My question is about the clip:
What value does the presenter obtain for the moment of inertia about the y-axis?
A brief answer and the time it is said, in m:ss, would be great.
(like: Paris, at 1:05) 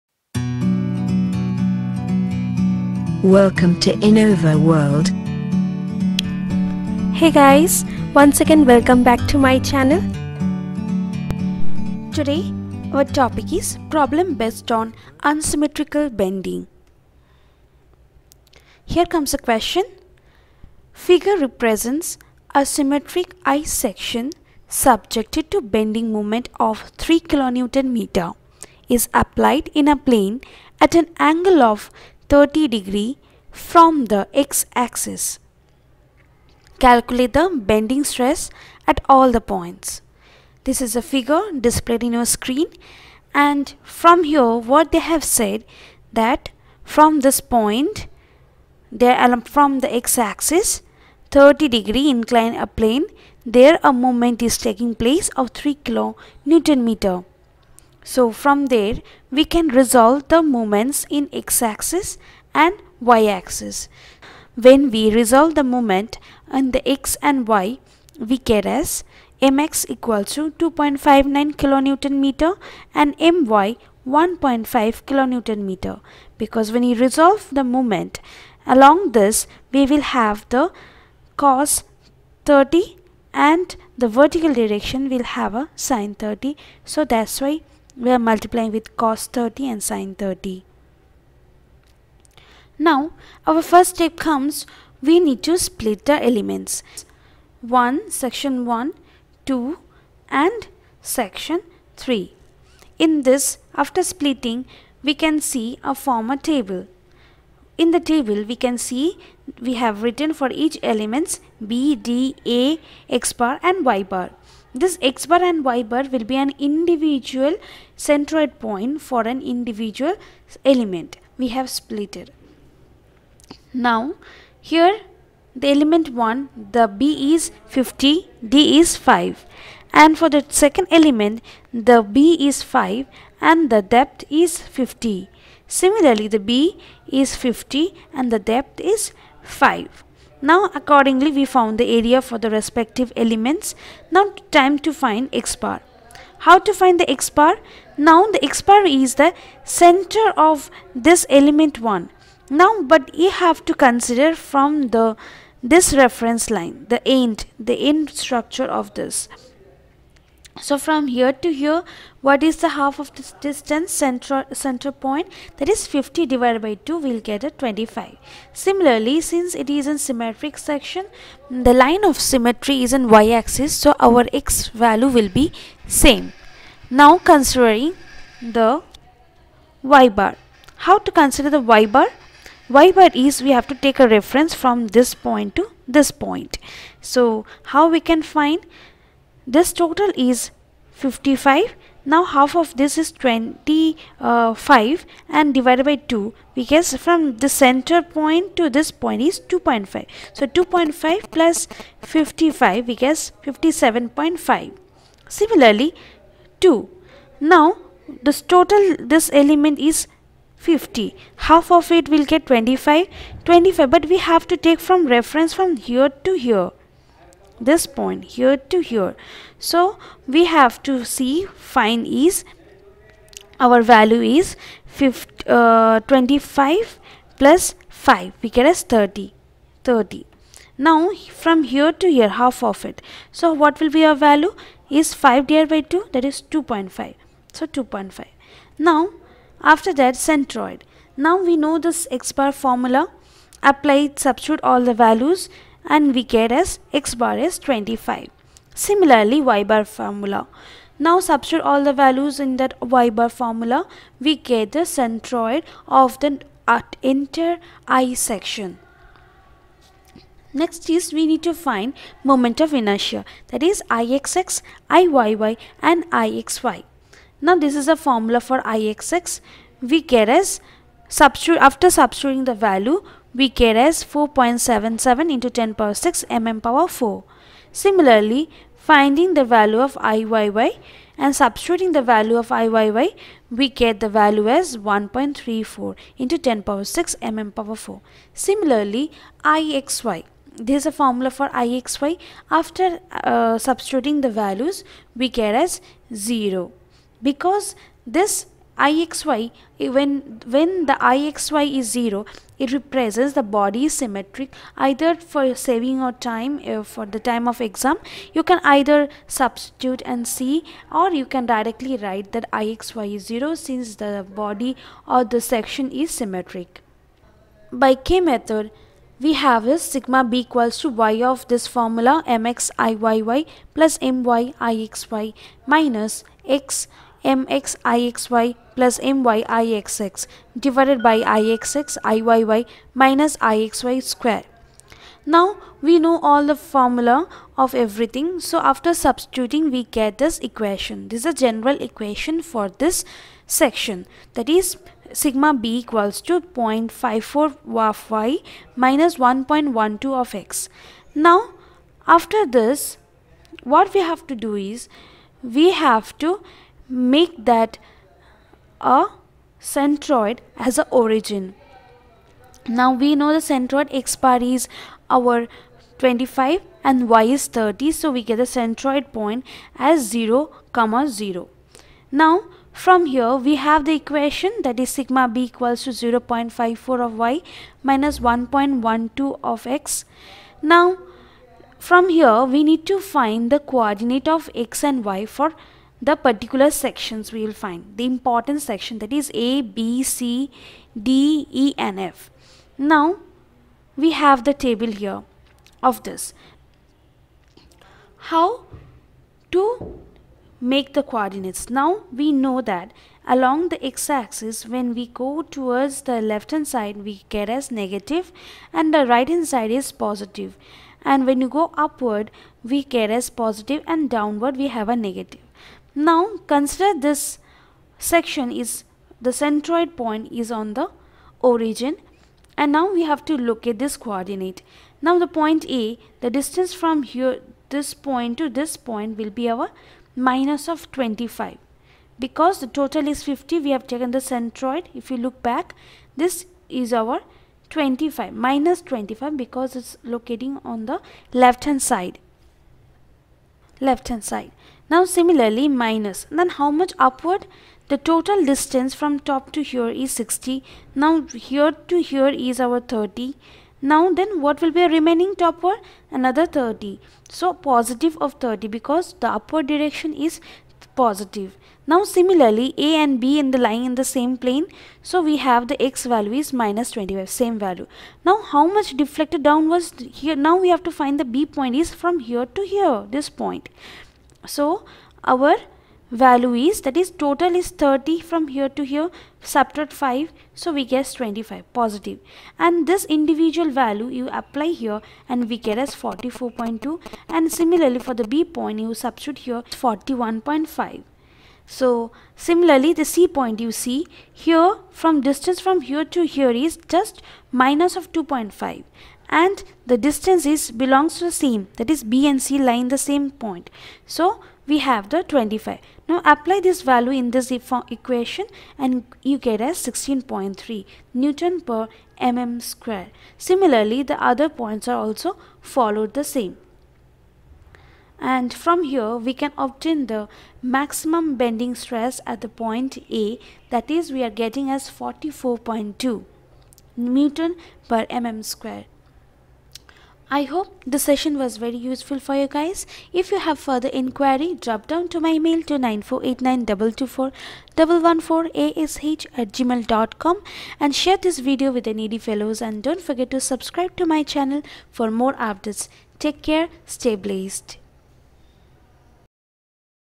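1.34 x 10^6 mm^4, at 4:44.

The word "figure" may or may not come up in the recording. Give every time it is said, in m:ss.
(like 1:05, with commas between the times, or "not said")
0:20, 0:41.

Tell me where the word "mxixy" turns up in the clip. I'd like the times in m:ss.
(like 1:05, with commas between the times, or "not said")
5:27.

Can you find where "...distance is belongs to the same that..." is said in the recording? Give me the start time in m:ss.
8:19.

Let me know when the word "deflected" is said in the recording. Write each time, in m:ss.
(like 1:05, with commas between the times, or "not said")
7:48.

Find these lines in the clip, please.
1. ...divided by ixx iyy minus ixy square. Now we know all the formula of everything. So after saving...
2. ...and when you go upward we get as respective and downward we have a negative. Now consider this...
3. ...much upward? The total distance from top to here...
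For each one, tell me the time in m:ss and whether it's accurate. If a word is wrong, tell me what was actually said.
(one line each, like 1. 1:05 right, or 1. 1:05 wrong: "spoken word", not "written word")
1. 5:30 wrong: "substituting", not "saving"
2. 6:51 wrong: "positive", not "respective"
3. 7:26 right.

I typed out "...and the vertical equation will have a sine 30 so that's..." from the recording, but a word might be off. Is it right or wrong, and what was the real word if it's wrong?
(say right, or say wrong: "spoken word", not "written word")
wrong: "direction", not "equation".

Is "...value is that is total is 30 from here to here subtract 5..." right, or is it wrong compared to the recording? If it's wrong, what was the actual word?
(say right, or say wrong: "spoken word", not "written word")
right.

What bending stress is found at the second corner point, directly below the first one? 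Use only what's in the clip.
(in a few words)
41.5.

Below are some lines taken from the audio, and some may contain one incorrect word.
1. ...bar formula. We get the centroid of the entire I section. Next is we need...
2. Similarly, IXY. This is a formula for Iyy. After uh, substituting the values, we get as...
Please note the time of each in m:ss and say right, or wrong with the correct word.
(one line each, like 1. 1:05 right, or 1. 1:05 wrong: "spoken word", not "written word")
1. 4:13 right
2. 4:48 wrong: "IXY", not "Iyy".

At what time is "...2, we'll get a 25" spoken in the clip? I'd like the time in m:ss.
2:46.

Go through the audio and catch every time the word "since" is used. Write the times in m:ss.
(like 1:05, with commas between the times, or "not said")
2:49, 5:13.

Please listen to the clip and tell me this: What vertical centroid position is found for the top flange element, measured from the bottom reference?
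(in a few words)
57.5.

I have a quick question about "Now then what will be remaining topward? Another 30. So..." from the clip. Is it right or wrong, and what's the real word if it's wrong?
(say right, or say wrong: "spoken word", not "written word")
right.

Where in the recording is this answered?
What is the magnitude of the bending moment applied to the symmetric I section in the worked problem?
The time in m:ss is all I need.
0:26.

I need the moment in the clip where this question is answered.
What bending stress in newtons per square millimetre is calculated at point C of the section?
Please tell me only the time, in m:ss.
8:29.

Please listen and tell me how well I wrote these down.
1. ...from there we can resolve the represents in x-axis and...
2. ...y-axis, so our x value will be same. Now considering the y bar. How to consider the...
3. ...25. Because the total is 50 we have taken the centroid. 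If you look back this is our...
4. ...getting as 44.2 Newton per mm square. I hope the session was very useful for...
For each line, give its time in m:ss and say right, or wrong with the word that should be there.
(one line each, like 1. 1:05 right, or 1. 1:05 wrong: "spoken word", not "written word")
1. 0:58 wrong: "moments", not "represents"
2. 2:53 right
3. 7:10 right
4. 8:44 right.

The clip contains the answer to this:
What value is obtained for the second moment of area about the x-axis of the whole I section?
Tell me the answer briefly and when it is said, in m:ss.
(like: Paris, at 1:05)
4.77 x 10^6 mm^4, at 4:34.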